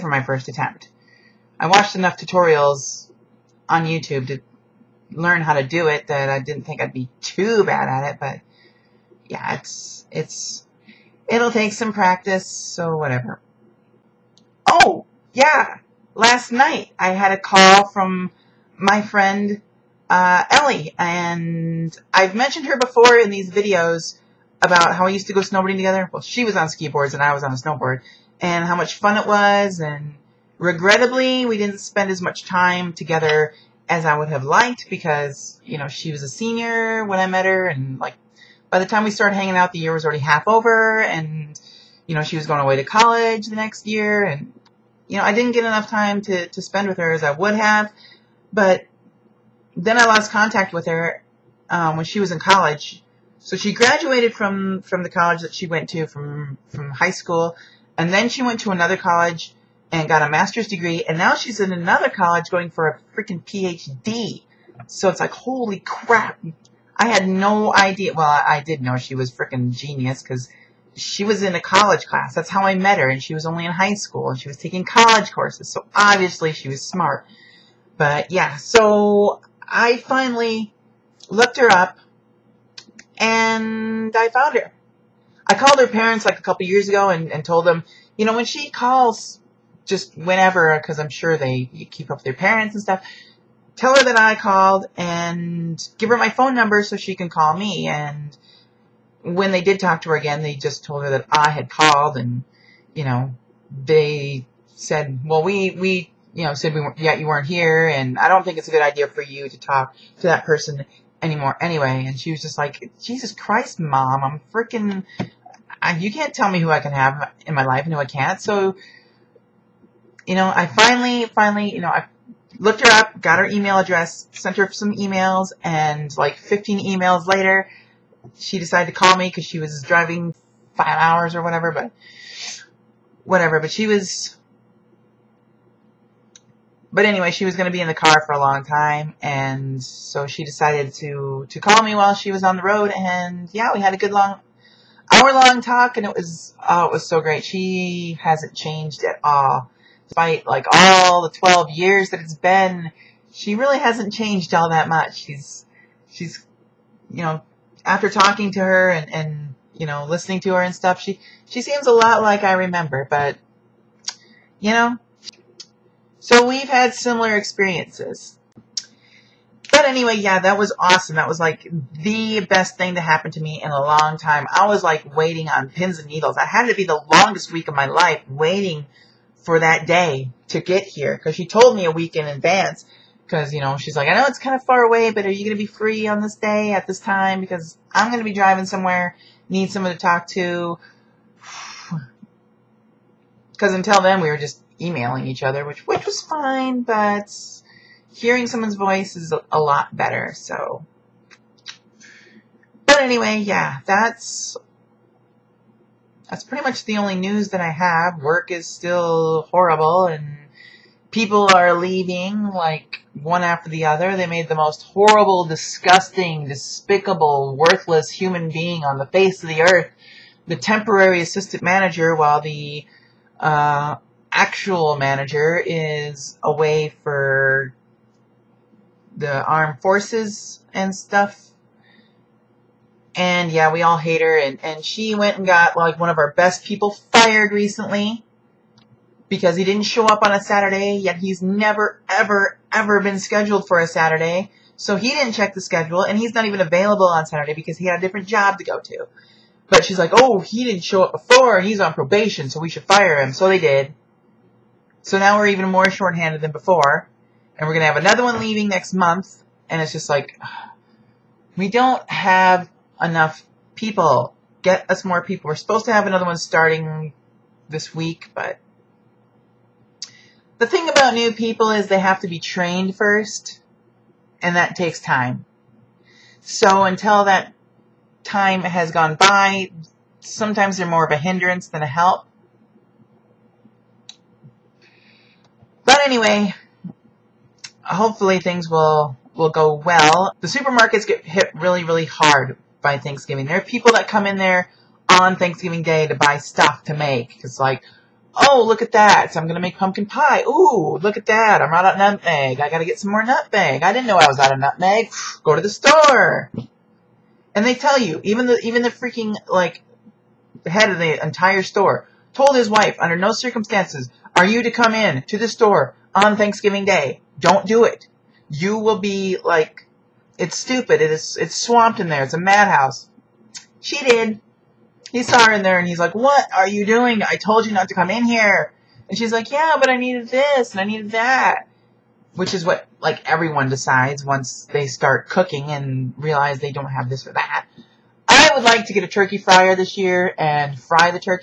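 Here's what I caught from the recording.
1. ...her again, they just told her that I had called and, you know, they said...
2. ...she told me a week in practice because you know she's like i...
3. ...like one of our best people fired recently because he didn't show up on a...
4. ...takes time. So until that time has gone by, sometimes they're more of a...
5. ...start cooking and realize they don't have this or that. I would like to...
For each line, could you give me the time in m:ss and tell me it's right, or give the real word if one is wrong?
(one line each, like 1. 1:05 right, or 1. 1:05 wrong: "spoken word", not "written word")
1. 1:40 right
2. 3:01 wrong: "advance", not "practice"
3. 3:55 right
4. 4:34 right
5. 5:34 right.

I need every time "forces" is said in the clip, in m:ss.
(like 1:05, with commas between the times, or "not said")
3:49.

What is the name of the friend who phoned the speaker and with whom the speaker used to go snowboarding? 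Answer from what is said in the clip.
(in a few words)
Ellie.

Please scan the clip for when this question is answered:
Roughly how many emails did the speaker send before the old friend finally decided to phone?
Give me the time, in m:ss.
2:06.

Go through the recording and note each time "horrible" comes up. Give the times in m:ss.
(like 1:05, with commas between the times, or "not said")
3:29, 3:34.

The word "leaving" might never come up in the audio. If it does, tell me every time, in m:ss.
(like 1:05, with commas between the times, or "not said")
3:31, 4:18.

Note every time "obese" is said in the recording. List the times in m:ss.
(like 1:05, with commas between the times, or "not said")
not said.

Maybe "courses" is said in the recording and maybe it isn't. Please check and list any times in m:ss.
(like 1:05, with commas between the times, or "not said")
1:15.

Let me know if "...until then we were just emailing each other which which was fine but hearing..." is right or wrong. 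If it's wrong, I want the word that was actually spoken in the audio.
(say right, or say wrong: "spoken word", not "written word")
right.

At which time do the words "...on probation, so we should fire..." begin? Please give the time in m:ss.
4:11.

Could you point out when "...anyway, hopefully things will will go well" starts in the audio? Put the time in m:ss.
4:46.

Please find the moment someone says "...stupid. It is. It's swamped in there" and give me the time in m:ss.
5:20.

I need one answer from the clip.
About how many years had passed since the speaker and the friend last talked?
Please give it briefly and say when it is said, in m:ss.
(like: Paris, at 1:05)
12, at 2:31.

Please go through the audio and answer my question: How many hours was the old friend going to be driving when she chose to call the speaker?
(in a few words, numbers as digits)
5.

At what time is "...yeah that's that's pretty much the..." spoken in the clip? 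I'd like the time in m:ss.
3:23.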